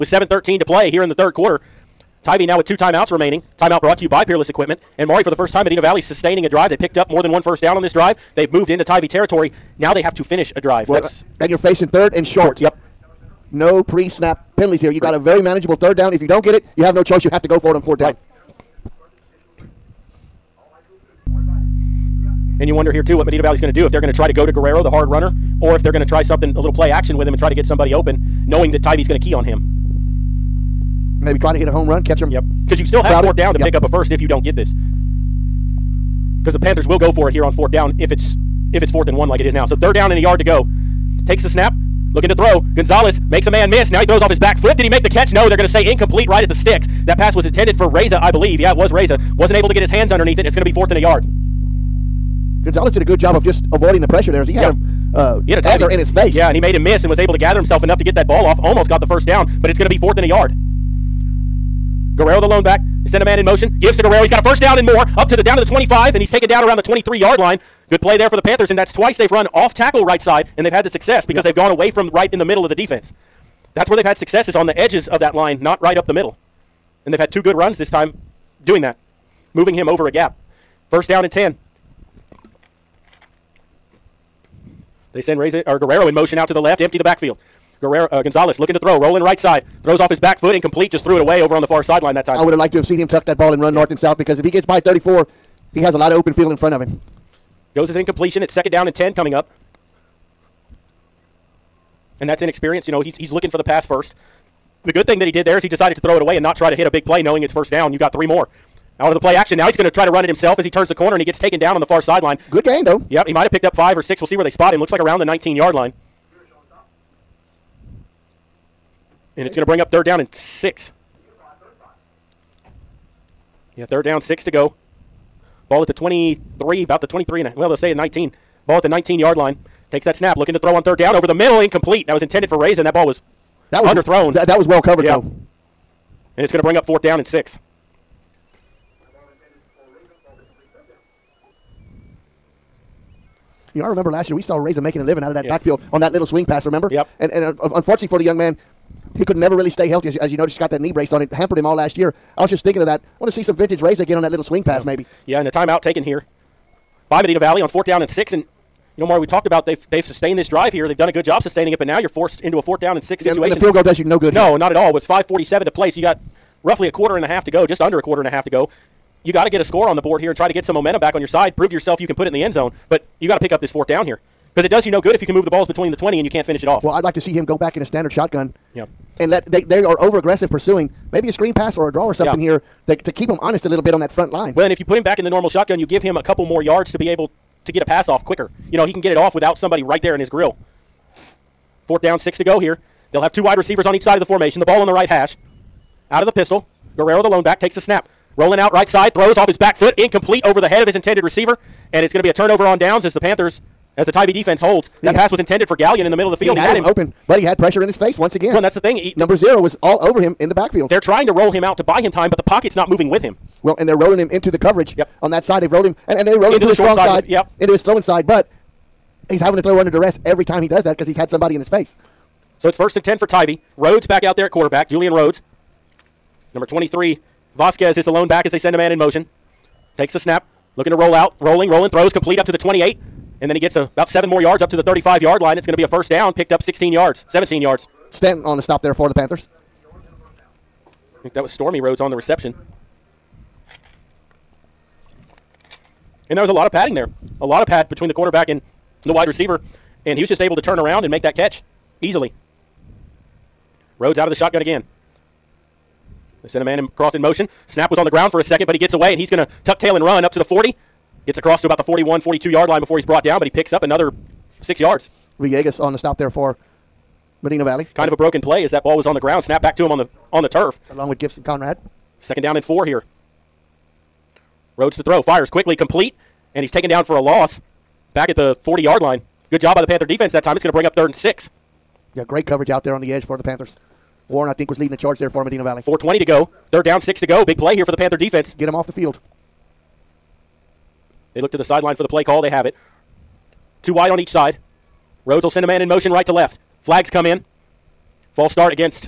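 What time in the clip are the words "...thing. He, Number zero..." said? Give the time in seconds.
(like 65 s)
208 s.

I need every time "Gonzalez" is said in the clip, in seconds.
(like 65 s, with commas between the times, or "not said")
42 s, 52 s, 88 s.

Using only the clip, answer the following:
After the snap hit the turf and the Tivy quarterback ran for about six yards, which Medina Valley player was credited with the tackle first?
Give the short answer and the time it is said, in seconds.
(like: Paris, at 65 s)
Villegas, at 265 s.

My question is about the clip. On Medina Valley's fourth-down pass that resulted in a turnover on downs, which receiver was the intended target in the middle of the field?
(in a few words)
Gallion.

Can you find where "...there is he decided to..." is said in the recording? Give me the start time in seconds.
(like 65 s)
105 s.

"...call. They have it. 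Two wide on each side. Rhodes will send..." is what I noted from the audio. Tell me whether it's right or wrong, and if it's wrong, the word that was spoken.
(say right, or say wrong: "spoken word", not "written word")
right.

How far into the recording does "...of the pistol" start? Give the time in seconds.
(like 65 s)
196 s.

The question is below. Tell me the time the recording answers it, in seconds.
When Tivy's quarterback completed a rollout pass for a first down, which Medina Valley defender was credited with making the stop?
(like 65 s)
238 s.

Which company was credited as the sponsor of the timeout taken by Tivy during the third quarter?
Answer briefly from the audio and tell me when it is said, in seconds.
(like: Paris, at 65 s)
Peerless Equipment, at 4 s.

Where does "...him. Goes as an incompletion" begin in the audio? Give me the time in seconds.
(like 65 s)
96 s.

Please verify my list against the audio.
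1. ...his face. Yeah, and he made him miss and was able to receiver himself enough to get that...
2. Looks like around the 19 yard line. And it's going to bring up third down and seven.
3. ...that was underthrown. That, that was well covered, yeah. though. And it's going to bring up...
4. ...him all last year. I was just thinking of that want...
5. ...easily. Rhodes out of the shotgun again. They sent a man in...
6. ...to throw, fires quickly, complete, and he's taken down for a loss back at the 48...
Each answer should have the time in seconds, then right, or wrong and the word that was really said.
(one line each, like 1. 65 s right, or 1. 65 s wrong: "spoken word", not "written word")
1. 55 s wrong: "gather", not "receiver"
2. 114 s wrong: "six", not "seven"
3. 133 s right
4. 151 s right
5. 252 s right
6. 274 s wrong: "40", not "48".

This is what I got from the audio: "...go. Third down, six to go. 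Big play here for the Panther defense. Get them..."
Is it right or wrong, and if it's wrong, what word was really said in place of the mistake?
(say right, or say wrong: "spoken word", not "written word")
right.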